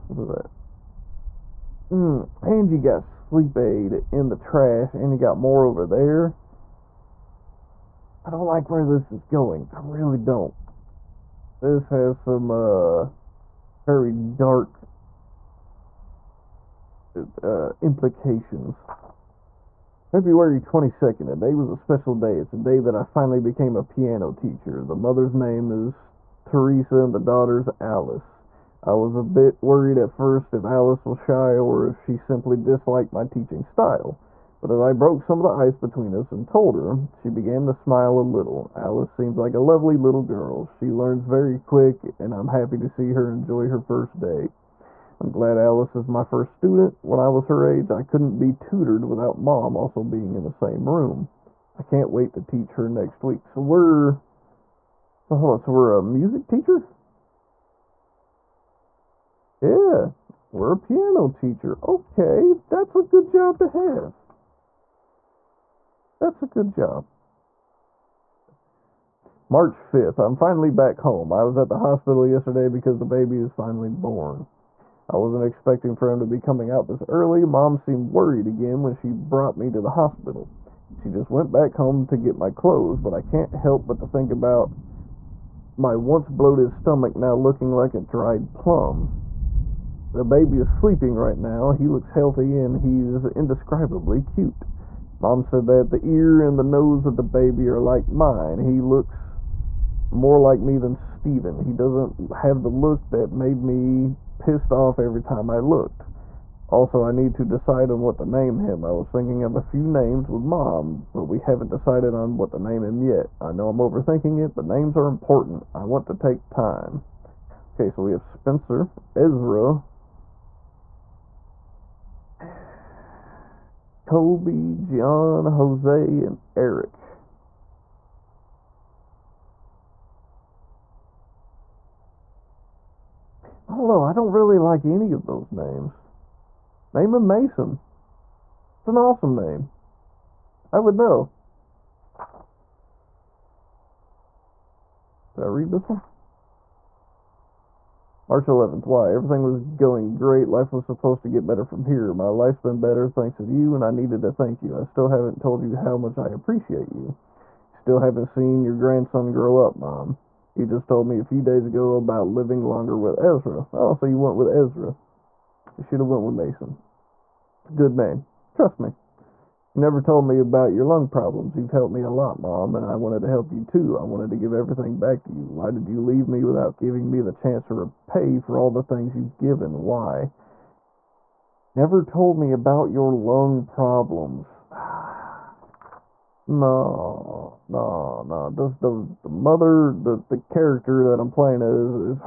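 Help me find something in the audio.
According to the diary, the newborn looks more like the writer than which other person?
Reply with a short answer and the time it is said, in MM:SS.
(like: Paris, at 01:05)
Steven, at 01:40.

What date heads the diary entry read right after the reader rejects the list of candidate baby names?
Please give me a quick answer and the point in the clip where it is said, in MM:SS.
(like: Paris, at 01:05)
March 11, at 02:28.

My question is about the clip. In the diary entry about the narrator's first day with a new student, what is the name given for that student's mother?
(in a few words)
Teresa.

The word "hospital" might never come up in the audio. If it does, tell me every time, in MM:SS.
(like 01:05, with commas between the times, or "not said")
01:11, 01:19.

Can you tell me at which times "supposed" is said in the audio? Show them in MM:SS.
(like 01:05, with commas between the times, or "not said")
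02:30.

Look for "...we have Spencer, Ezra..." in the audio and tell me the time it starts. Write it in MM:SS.
01:58.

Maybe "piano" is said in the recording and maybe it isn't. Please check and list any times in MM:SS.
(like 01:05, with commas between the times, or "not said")
00:23, 01:00.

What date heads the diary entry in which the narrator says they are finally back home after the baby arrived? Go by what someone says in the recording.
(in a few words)
March 5.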